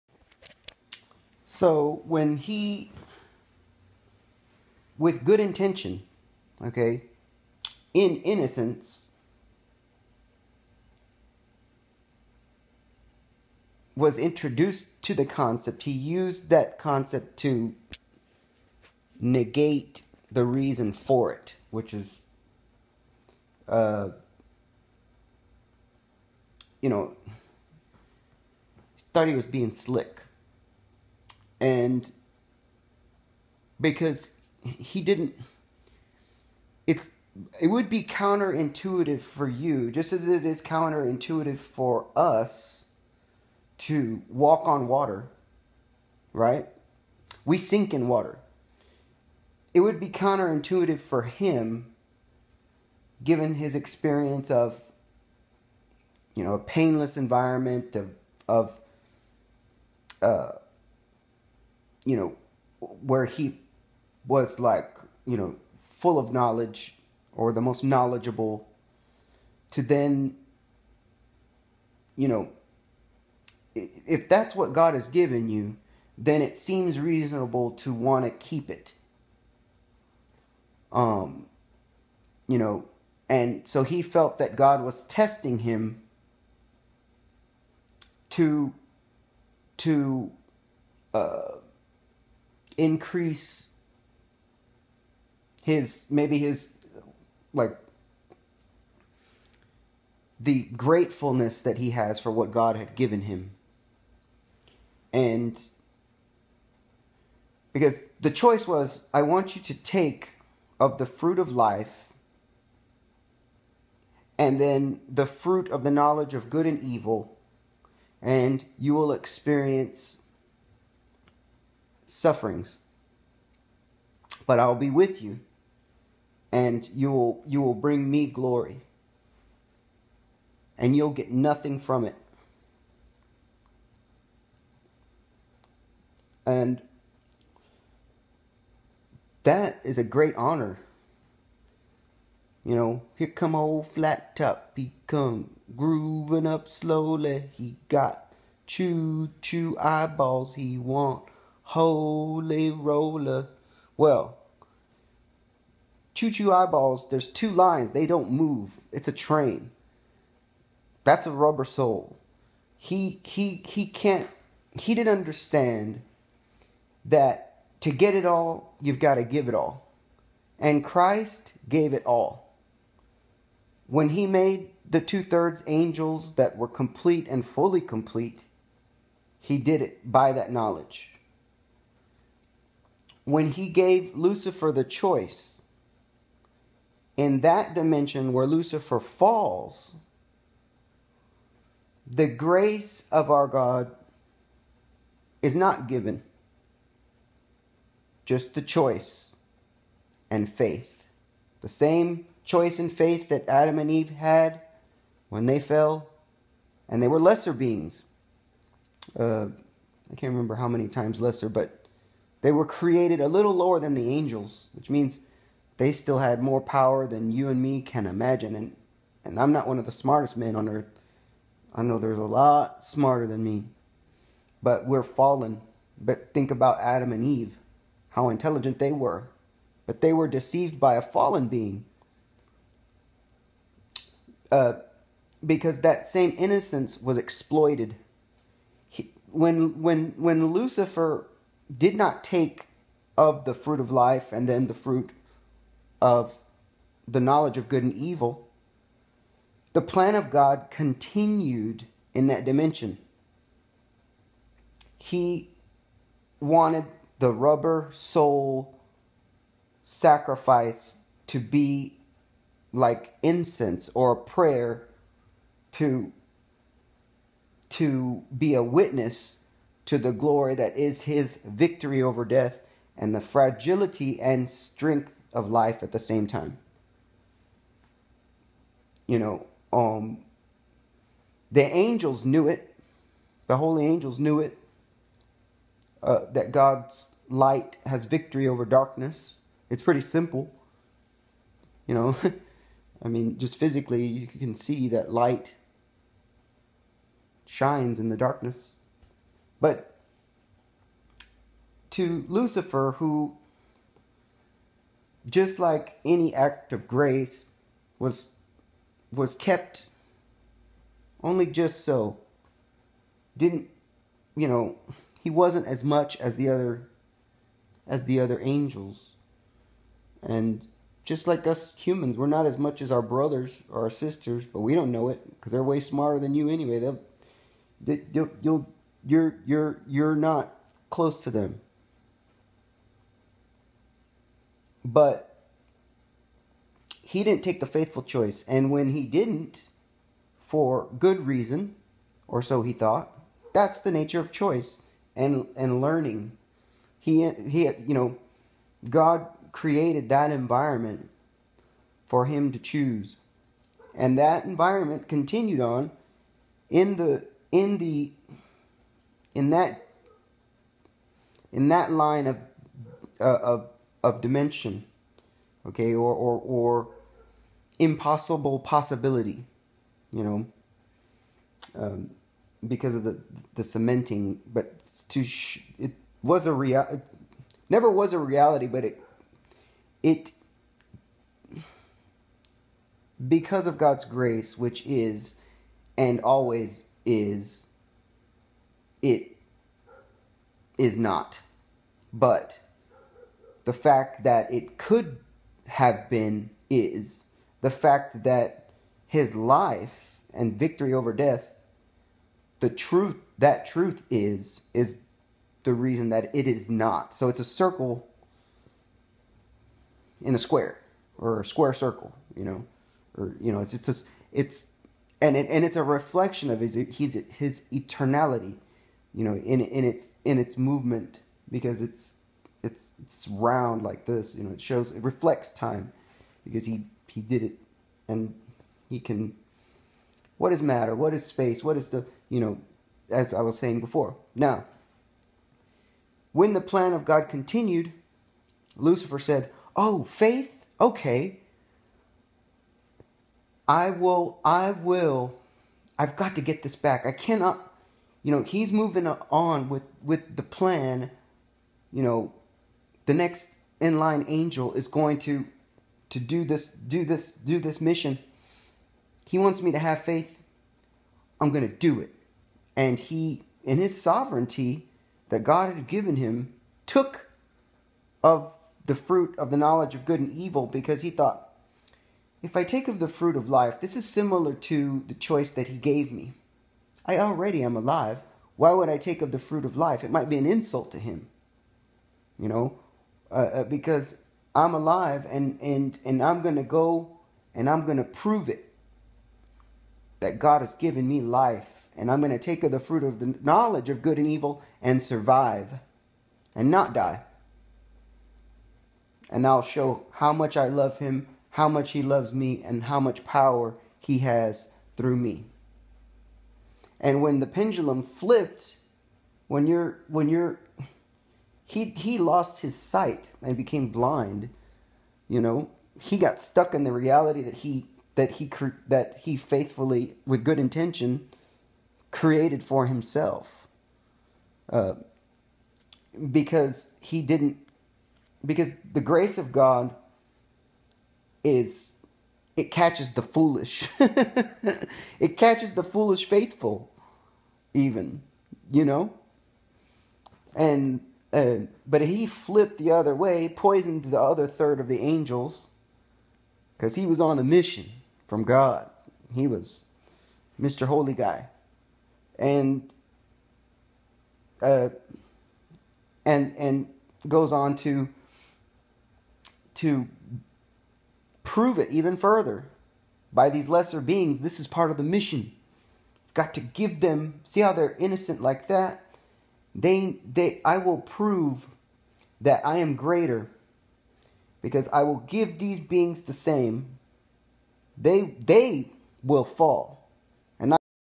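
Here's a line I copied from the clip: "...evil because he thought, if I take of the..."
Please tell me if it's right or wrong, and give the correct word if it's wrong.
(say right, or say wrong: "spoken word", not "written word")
right.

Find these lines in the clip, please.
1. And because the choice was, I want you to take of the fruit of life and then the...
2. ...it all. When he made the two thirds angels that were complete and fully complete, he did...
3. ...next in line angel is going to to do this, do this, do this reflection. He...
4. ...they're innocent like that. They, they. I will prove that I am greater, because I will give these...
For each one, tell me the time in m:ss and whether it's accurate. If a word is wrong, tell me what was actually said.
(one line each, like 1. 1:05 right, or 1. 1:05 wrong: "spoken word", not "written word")
1. 1:45 right
2. 2:51 right
3. 7:33 wrong: "mission", not "reflection"
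4. 9:27 right.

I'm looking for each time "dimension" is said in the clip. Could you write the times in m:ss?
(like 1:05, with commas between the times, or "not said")
3:07, 4:12, 6:04.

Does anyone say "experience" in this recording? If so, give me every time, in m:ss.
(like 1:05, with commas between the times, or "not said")
0:53, 1:59.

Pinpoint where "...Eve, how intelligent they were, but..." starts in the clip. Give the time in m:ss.
3:47.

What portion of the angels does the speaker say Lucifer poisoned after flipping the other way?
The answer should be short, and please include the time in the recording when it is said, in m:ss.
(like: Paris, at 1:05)
the other third, at 9:04.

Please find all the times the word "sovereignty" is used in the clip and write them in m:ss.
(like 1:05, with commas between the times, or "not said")
7:43.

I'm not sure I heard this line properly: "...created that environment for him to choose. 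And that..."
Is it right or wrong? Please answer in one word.
right.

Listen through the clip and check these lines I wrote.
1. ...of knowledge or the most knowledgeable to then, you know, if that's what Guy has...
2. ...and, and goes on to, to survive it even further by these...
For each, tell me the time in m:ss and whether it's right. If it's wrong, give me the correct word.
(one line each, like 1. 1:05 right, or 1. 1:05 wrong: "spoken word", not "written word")
1. 1:06 wrong: "God", not "Guy"
2. 9:16 wrong: "prove", not "survive".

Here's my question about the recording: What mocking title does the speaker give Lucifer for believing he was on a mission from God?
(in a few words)
Mr. Holy Guy.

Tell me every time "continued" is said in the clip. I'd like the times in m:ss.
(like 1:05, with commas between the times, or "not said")
4:10, 5:55, 7:17.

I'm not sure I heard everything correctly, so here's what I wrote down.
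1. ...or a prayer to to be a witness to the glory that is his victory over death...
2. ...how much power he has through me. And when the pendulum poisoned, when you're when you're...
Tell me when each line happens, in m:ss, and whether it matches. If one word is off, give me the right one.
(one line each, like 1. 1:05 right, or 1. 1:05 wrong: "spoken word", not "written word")
1. 4:23 right
2. 8:22 wrong: "flipped", not "poisoned".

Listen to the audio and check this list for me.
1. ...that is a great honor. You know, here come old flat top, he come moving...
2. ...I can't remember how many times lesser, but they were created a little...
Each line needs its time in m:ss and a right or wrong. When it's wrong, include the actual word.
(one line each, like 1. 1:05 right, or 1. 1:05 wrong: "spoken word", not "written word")
1. 2:19 wrong: "grooving", not "moving"
2. 3:30 right.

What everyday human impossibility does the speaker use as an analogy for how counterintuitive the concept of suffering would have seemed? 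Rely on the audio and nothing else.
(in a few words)
walk on water.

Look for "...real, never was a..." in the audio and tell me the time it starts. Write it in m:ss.
6:16.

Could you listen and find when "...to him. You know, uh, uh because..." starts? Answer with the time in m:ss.
8:00.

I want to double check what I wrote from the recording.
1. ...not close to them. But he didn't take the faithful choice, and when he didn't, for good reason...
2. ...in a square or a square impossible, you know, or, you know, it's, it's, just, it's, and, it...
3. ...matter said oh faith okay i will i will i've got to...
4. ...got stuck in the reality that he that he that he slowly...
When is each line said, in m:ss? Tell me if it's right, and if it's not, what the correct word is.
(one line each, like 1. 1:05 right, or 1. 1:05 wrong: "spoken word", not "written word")
1. 5:30 right
2. 6:50 wrong: "circle", not "impossible"
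3. 7:18 wrong: "lucifer", not "matter"
4. 8:36 wrong: "faithfully", not "slowly".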